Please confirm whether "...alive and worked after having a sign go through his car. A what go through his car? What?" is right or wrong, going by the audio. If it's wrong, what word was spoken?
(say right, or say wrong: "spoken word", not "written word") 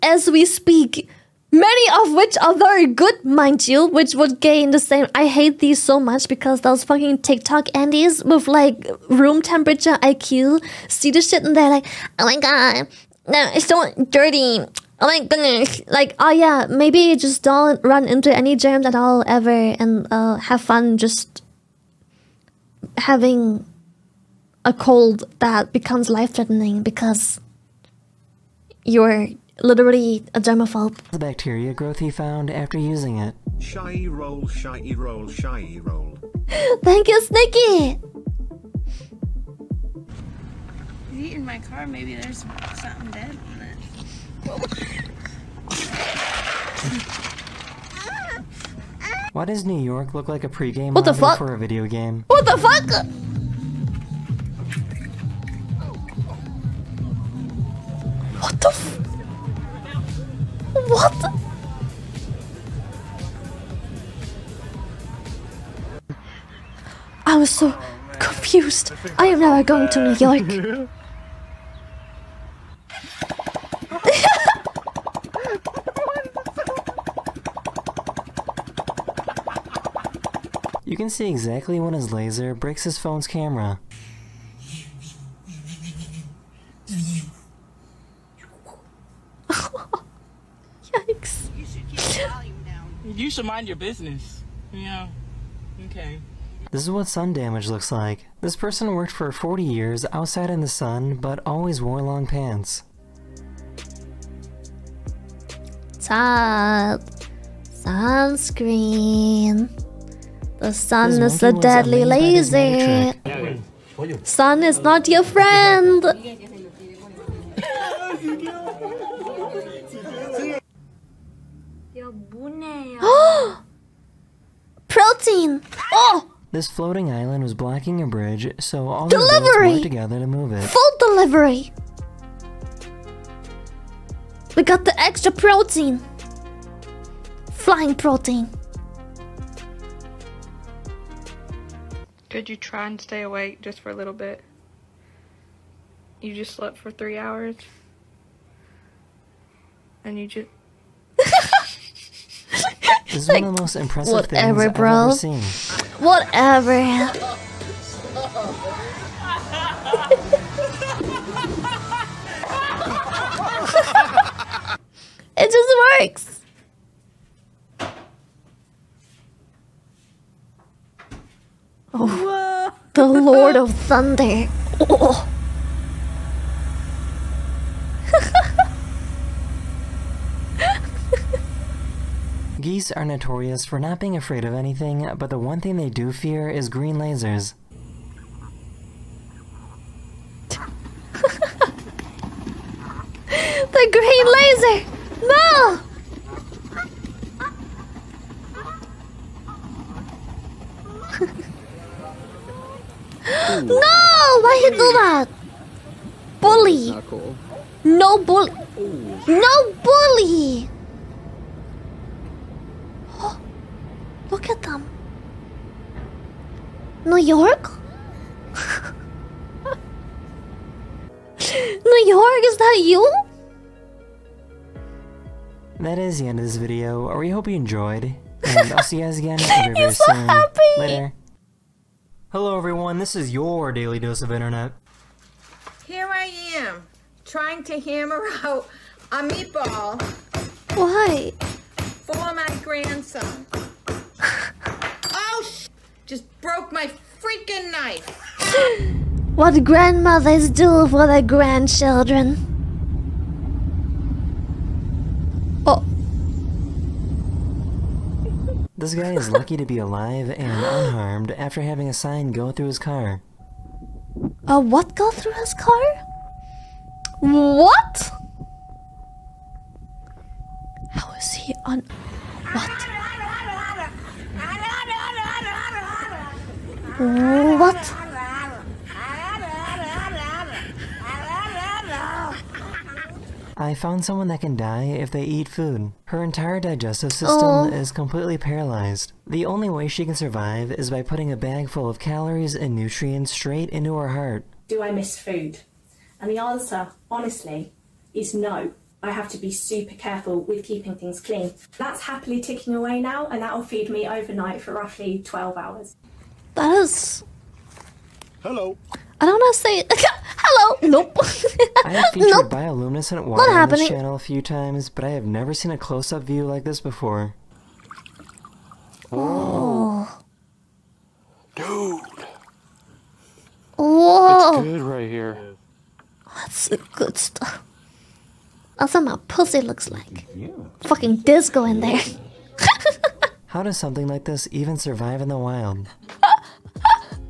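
wrong: "unharmed", not "worked".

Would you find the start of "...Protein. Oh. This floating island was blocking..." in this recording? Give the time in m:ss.
2:04.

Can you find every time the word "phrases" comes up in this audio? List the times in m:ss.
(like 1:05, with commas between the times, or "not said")
not said.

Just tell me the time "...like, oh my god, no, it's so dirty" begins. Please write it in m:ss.
0:11.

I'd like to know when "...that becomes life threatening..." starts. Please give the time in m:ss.
0:25.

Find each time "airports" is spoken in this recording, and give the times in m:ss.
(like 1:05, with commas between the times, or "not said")
not said.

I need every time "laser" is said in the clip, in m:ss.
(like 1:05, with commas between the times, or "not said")
1:22, 3:06.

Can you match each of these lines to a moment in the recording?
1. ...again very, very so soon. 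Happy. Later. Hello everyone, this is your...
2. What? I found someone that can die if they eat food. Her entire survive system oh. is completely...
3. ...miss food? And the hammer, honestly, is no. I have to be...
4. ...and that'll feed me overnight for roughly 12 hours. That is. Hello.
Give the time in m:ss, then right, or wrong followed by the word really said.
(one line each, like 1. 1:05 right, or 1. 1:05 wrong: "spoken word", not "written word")
1. 3:49 right
2. 4:37 wrong: "digestive", not "survive"
3. 4:54 wrong: "answer", not "hammer"
4. 5:03 right.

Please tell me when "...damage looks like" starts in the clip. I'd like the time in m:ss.
1:37.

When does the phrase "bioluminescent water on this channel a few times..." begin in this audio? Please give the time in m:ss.
5:12.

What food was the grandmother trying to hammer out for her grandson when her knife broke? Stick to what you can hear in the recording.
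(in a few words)
A meatball.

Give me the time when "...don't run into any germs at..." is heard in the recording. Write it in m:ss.
0:17.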